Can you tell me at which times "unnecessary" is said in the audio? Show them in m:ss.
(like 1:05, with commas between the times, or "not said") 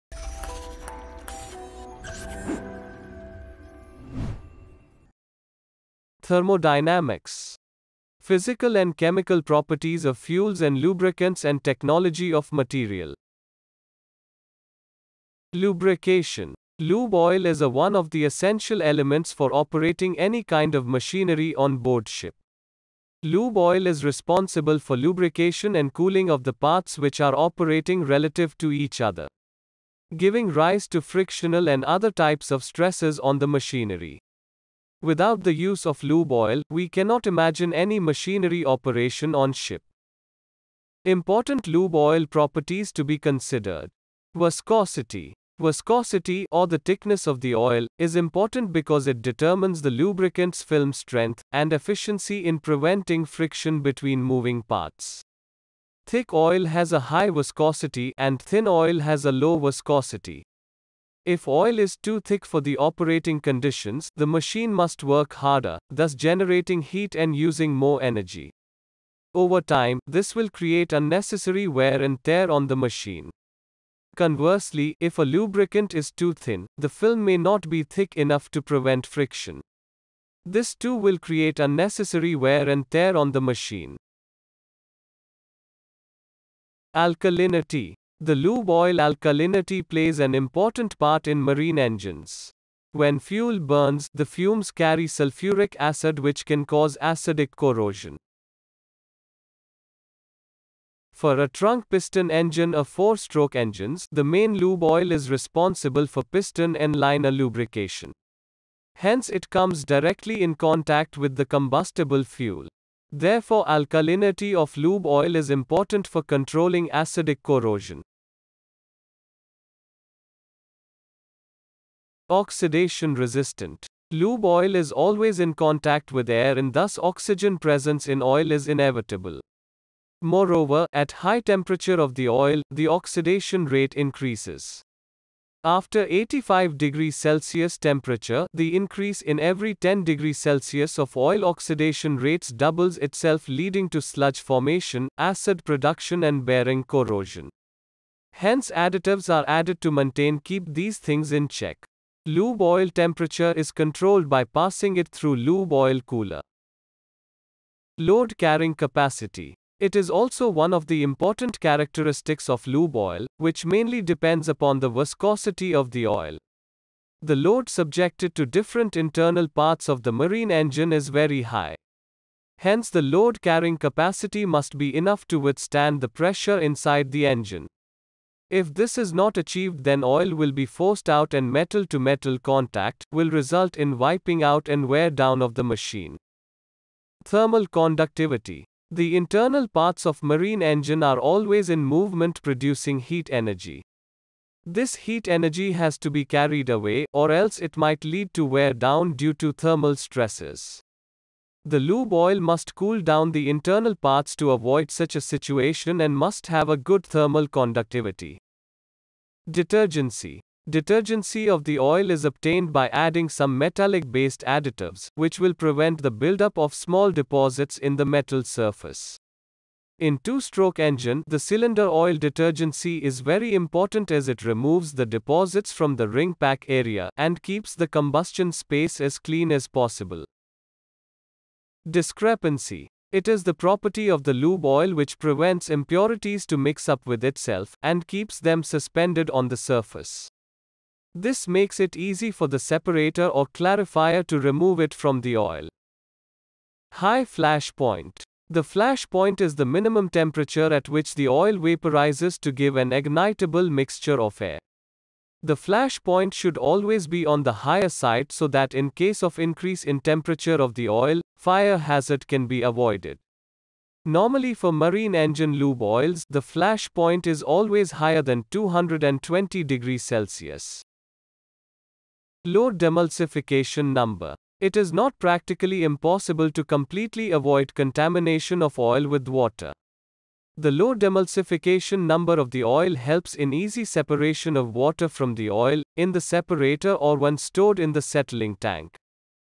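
1:10, 1:21.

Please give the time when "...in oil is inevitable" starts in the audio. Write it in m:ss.
2:08.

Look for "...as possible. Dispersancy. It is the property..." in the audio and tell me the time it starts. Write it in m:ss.
3:49.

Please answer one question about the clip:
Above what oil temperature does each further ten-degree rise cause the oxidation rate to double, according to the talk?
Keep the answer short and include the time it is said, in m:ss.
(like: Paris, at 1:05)
85 degrees Celsius, at 2:16.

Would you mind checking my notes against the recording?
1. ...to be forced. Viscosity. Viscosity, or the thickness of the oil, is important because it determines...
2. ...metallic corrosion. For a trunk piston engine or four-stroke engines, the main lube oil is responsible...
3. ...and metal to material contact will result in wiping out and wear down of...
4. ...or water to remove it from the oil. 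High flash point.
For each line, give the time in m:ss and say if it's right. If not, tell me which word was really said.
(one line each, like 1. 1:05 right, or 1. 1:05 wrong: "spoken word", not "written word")
1. 0:42 wrong: "considered", not "forced"
2. 1:37 wrong: "acidic", not "metallic"
3. 3:01 wrong: "metal", not "material"
4. 4:03 wrong: "clarifier", not "water".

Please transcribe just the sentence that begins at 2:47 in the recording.
The load subjected to different internal parts of the marine engine is very high.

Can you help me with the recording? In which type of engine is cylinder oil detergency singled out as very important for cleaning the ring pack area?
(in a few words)
two-stroke engine.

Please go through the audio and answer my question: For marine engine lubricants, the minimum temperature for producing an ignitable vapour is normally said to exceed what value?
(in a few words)
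220 degrees Celsius.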